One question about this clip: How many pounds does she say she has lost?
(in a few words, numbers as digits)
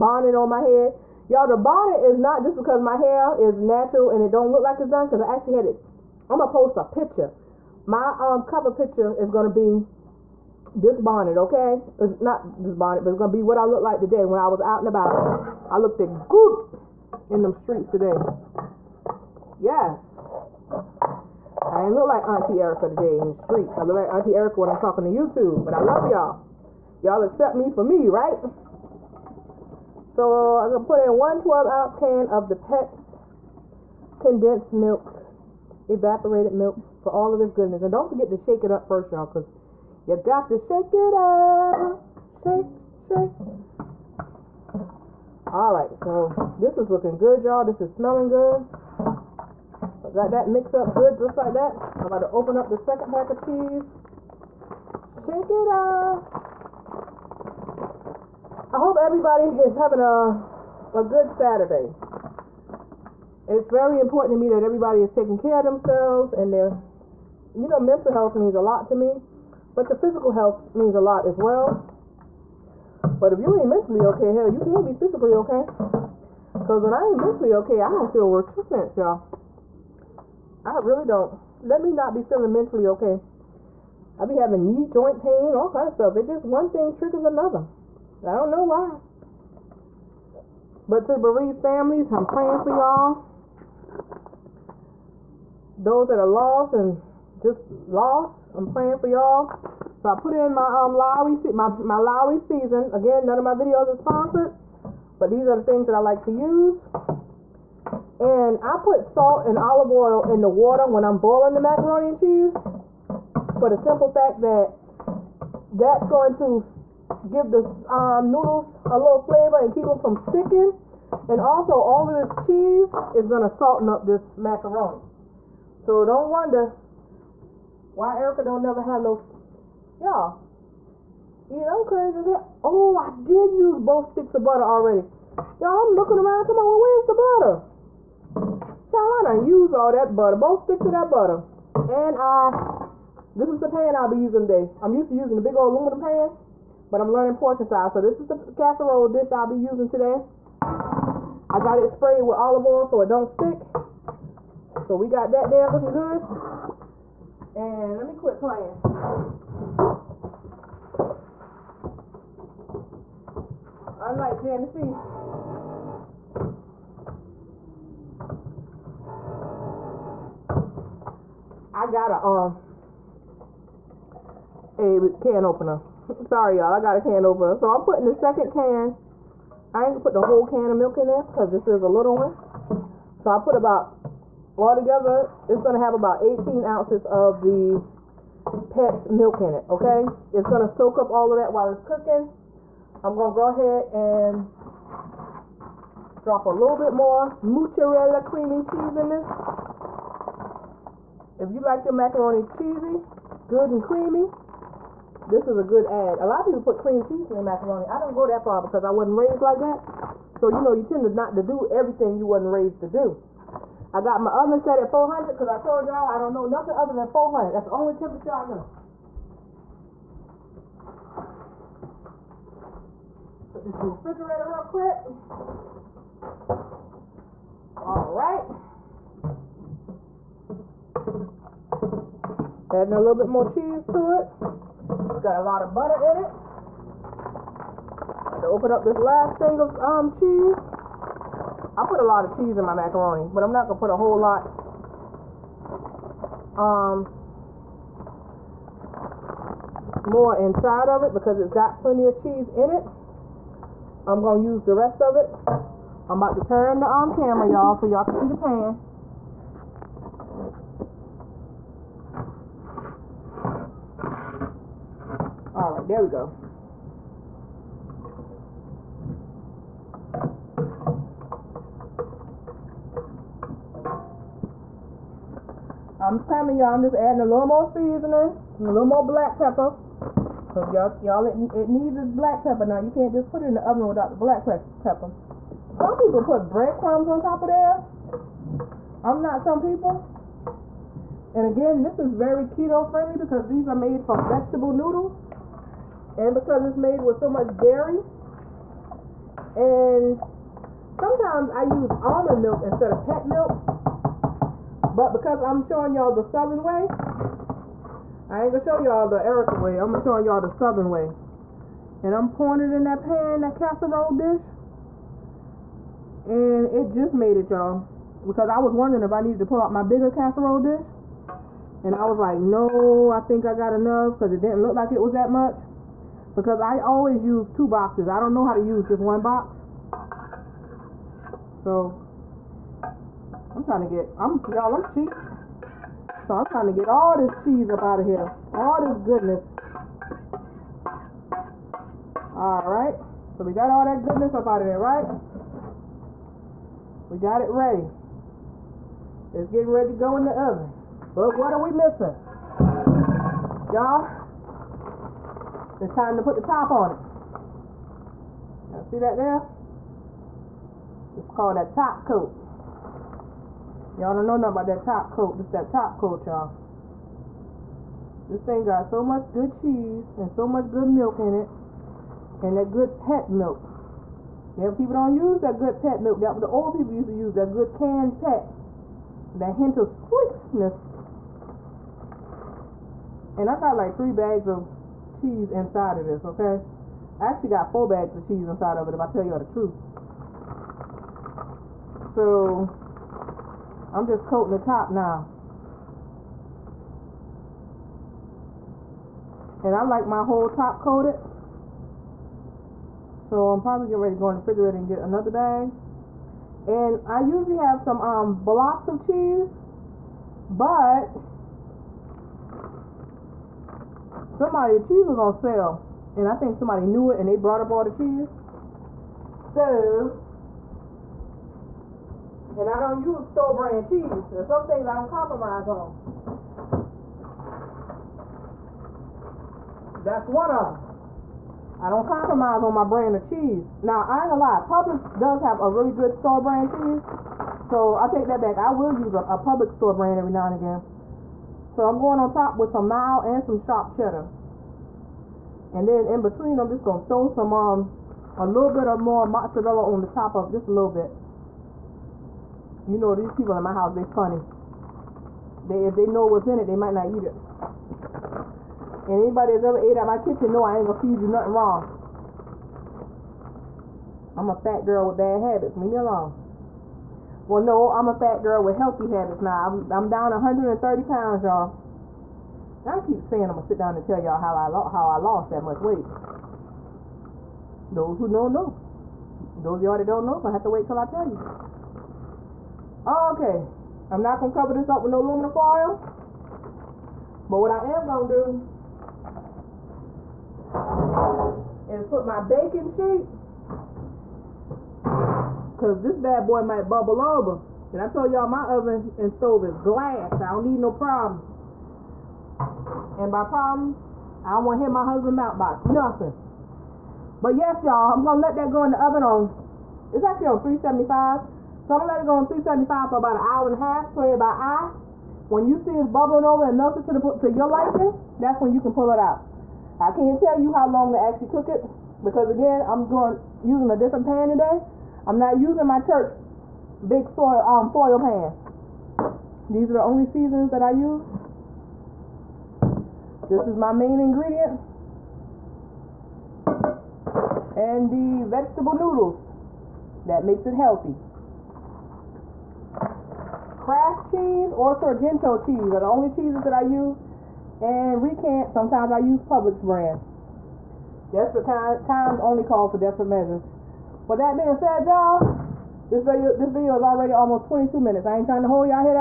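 130.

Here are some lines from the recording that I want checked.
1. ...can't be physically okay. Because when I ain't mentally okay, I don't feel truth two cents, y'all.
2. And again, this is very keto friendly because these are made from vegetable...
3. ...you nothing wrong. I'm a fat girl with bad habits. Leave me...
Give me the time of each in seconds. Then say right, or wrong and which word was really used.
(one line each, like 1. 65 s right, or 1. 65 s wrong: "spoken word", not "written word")
1. 74 s wrong: "worth", not "truth"
2. 291 s right
3. 461 s right.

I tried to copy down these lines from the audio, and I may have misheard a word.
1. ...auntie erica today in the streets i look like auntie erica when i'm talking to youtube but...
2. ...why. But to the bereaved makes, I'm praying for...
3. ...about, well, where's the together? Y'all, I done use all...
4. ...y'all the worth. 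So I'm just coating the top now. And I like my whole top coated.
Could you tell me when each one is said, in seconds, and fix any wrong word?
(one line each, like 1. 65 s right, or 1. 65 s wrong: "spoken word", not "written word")
1. 22 s right
2. 88 s wrong: "families", not "makes"
3. 136 s wrong: "butter", not "together"
4. 389 s wrong: "truth", not "worth".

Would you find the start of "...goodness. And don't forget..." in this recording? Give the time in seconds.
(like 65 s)
37 s.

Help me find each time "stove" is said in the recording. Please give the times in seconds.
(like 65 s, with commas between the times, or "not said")
499 s.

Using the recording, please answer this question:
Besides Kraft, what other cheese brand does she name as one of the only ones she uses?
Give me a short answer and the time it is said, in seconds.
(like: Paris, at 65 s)
Sorrento, at 544 s.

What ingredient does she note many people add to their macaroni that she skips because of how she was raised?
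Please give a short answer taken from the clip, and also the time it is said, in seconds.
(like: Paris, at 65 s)
cream cheese, at 206 s.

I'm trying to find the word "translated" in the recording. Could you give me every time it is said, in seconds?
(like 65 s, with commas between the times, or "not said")
not said.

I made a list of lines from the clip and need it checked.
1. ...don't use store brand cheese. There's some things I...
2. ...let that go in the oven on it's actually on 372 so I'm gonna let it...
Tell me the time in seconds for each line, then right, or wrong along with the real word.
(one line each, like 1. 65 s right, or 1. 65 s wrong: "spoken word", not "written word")
1. 422 s right
2. 508 s wrong: "375", not "372".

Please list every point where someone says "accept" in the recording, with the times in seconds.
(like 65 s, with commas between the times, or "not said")
27 s.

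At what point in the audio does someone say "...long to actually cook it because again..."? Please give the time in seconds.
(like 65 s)
520 s.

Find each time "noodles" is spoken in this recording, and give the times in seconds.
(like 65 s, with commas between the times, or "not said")
118 s, 294 s, 538 s.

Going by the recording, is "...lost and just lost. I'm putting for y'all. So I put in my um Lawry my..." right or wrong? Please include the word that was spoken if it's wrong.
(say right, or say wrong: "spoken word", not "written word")
wrong: "praying", not "putting".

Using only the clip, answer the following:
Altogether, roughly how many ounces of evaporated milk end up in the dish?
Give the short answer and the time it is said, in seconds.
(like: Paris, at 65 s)
18, at 186 s.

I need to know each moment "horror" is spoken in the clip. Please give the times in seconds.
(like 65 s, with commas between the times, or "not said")
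not said.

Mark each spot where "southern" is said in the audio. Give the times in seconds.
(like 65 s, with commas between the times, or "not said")
306 s, 310 s.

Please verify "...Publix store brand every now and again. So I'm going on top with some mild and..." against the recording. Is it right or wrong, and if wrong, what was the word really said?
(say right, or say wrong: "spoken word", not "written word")
right.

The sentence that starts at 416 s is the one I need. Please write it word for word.
And I think somebody knew it and they brought up all the cheese.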